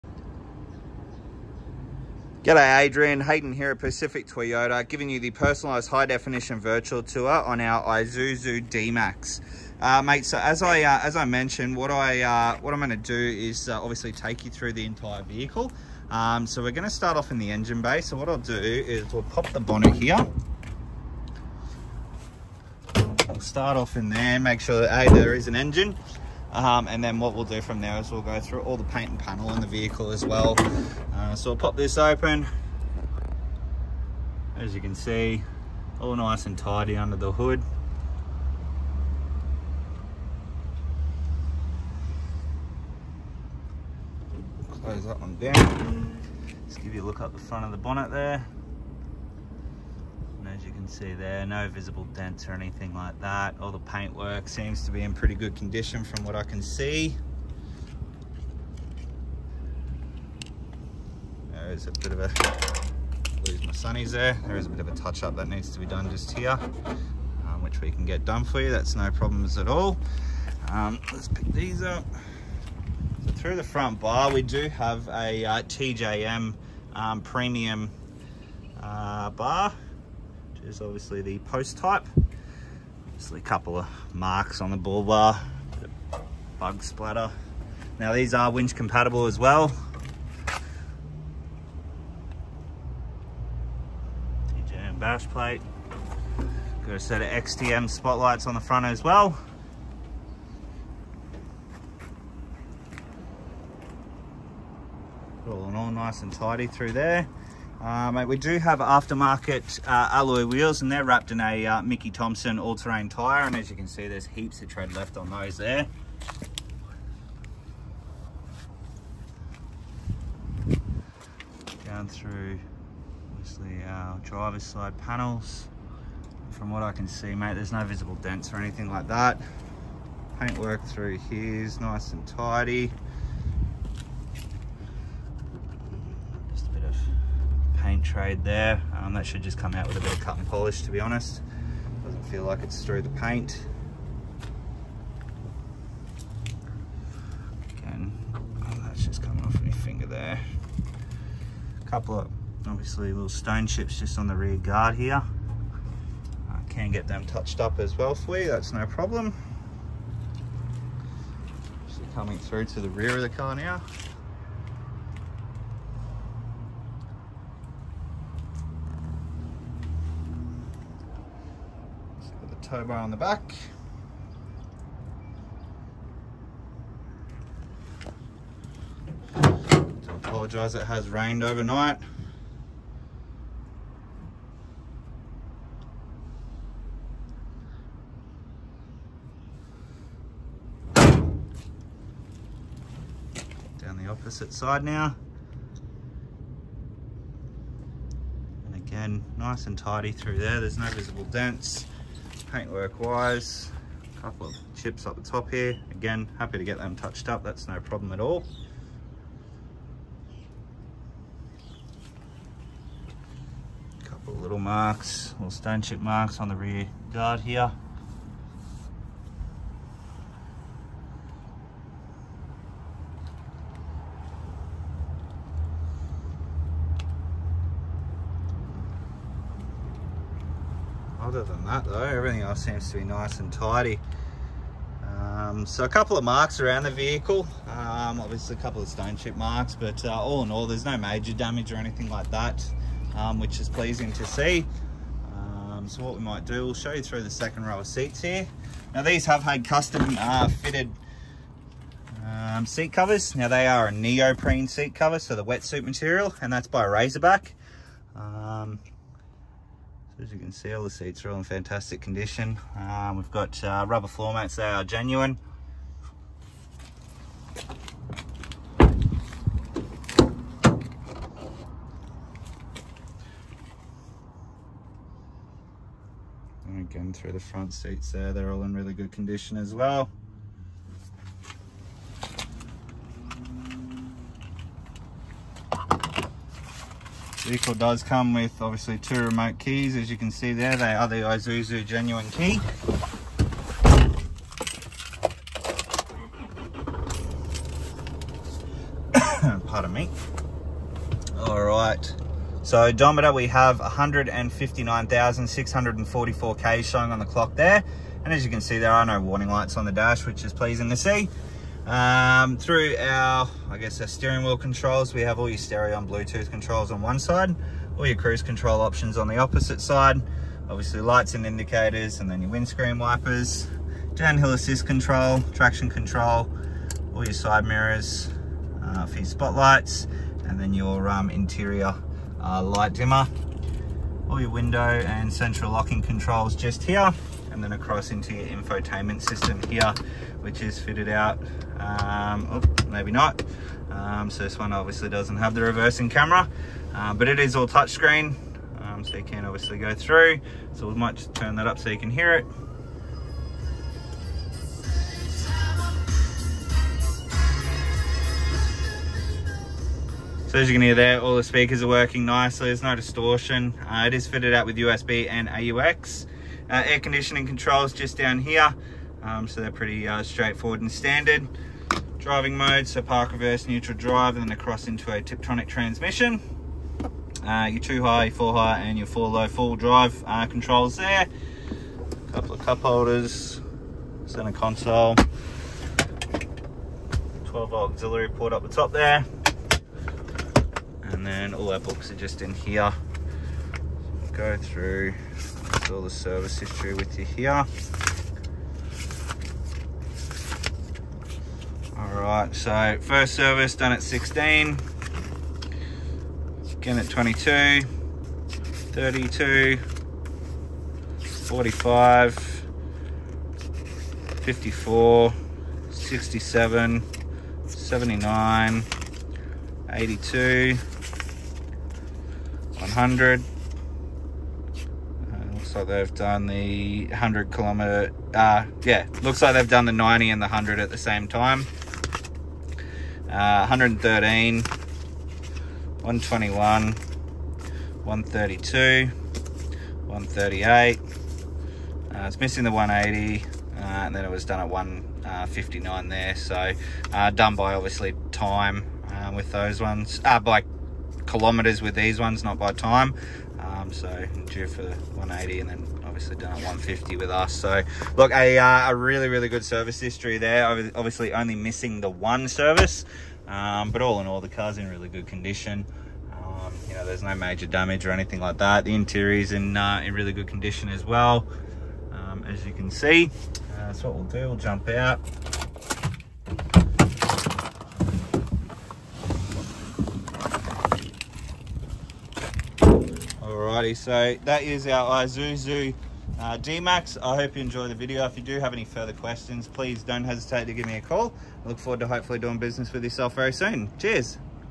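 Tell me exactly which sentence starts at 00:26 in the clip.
Um, and then what we'll do from there is we'll go through all the paint and panel on the vehicle as well.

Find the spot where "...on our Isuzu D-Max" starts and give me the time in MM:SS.
00:07.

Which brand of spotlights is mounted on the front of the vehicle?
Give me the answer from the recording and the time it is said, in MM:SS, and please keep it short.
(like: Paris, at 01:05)
XTM, at 01:37.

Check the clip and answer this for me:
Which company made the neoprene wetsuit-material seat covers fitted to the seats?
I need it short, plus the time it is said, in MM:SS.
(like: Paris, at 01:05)
Razorback, at 04:16.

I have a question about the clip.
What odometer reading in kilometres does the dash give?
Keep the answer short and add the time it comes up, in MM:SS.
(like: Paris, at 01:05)
159,644, at 05:03.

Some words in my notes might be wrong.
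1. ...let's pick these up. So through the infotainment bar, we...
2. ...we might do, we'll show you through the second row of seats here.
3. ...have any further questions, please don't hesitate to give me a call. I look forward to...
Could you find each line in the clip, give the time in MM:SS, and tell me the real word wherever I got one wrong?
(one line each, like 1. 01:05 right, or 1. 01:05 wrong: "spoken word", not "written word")
1. 01:11 wrong: "front", not "infotainment"
2. 04:06 right
3. 08:08 right.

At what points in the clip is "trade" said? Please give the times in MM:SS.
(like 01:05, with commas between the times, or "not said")
02:18.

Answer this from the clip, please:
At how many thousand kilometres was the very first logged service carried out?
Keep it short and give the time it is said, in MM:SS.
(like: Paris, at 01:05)
16, at 06:44.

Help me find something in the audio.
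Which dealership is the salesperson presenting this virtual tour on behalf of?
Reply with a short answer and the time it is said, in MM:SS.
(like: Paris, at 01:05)
Pacific Toyota, at 00:03.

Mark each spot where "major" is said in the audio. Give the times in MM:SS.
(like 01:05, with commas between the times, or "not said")
04:00, 07:47.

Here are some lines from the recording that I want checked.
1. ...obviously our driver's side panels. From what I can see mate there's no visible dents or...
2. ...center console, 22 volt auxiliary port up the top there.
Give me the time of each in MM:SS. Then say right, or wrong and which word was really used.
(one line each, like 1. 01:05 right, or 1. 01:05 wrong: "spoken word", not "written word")
1. 02:03 right
2. 06:24 wrong: "12", not "22".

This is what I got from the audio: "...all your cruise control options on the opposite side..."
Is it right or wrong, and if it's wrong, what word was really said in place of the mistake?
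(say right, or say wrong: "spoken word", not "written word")
right.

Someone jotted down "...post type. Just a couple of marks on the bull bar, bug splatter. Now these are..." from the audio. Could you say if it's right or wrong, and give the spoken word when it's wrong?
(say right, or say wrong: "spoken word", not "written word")
right.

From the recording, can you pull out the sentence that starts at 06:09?
Um, so they're pretty uh, straightforward and standard.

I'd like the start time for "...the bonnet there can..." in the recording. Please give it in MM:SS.
00:47.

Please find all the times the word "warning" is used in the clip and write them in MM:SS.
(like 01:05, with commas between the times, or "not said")
05:09.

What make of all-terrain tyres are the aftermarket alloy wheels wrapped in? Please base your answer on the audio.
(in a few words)
Mickey Thompson.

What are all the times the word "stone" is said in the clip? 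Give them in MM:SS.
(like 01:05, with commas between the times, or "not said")
02:33, 03:35, 03:58.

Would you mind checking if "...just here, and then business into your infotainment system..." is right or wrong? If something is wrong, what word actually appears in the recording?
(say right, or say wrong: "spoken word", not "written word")
wrong: "across", not "business".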